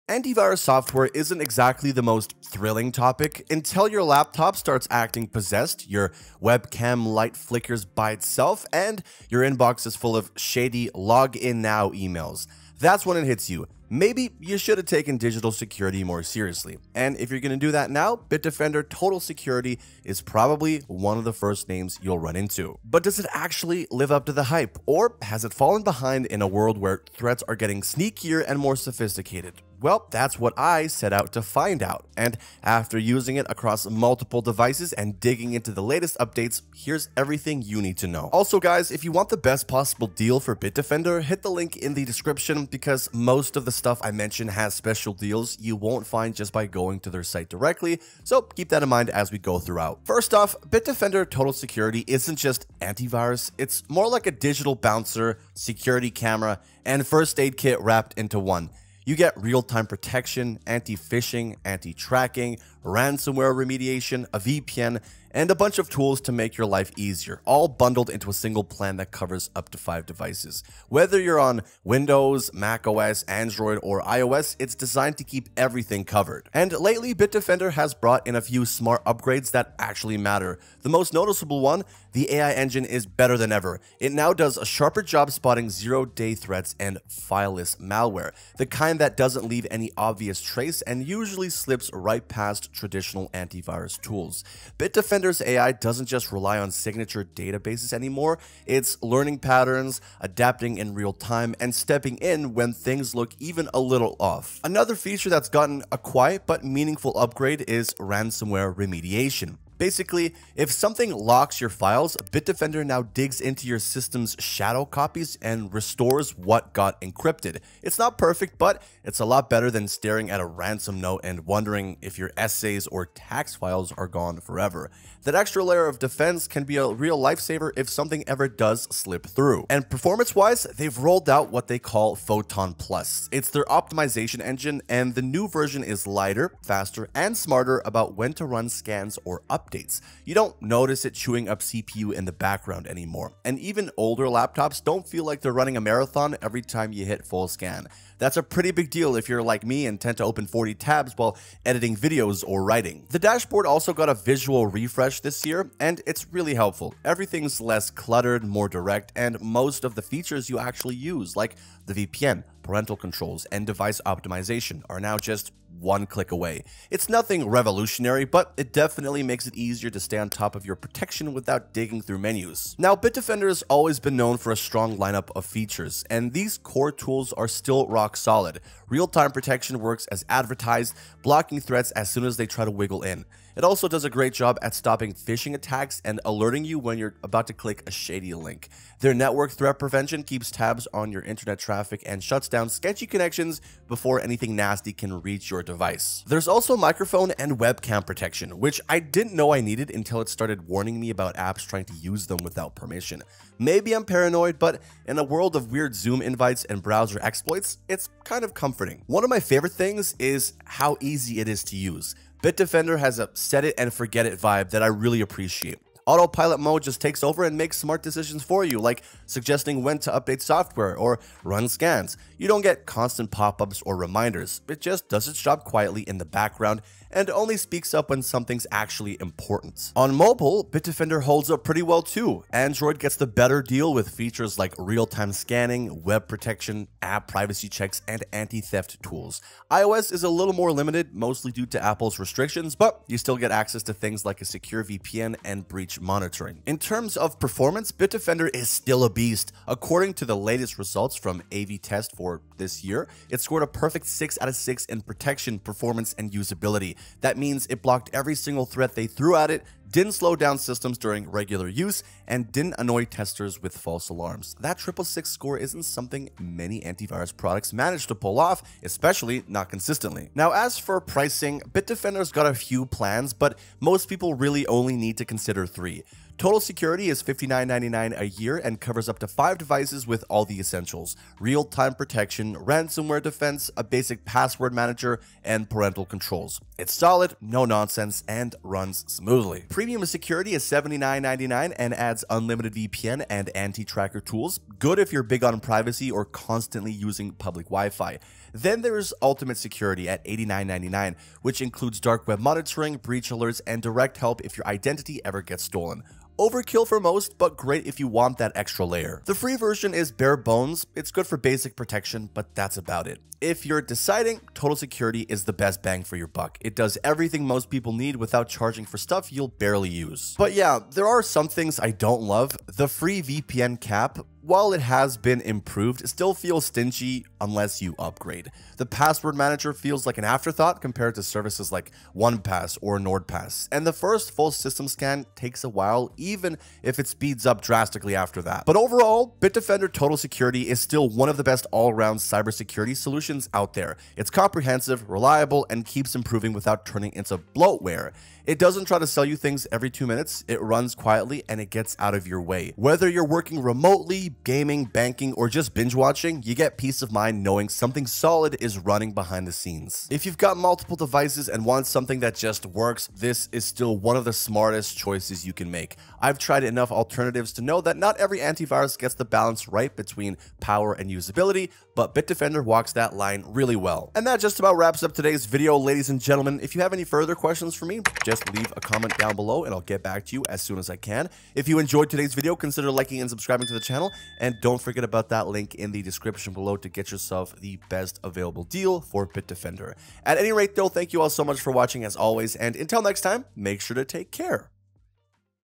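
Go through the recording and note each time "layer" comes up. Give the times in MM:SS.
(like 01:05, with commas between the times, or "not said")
02:05, 05:08.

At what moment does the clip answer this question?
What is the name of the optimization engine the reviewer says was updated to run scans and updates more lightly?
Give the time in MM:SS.
02:12.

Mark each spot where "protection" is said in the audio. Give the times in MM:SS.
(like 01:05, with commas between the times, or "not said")
00:59, 02:50, 02:59, 03:18, 03:56, 04:15, 04:41, 05:11.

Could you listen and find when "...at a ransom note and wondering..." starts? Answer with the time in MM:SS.
02:00.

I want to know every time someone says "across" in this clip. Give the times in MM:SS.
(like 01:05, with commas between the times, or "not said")
00:33.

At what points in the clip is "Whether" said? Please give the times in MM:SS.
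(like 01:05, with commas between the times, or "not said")
01:10, 05:52.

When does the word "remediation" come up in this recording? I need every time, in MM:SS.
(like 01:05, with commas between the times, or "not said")
01:03, 01:48.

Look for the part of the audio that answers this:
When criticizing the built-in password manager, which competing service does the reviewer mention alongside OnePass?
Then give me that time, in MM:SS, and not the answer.
05:32.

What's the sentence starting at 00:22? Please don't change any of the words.
But does it actually live up to the hype?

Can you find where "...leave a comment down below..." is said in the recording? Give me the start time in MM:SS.
06:18.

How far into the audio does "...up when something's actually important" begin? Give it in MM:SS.
03:47.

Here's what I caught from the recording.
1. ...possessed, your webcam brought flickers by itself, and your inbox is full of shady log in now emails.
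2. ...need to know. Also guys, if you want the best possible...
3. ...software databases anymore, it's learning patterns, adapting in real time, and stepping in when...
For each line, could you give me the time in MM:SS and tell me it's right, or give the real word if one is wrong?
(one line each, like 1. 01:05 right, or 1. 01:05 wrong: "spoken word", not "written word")
1. 00:05 wrong: "light", not "brought"
2. 00:37 right
3. 01:36 wrong: "signature", not "software".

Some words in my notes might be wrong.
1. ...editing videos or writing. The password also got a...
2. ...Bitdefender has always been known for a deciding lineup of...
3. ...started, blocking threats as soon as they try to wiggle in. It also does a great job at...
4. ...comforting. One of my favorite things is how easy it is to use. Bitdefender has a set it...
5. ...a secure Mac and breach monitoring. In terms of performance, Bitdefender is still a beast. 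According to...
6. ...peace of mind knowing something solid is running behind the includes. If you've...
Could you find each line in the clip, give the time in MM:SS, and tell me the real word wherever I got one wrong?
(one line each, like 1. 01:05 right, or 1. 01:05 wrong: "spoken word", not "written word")
1. 02:31 wrong: "dashboard", not "password"
2. 02:52 wrong: "strong", not "deciding"
3. 03:00 wrong: "advertised", not "started"
4. 03:28 right
5. 04:04 wrong: "VPN", not "Mac"
6. 05:56 wrong: "scenes", not "includes".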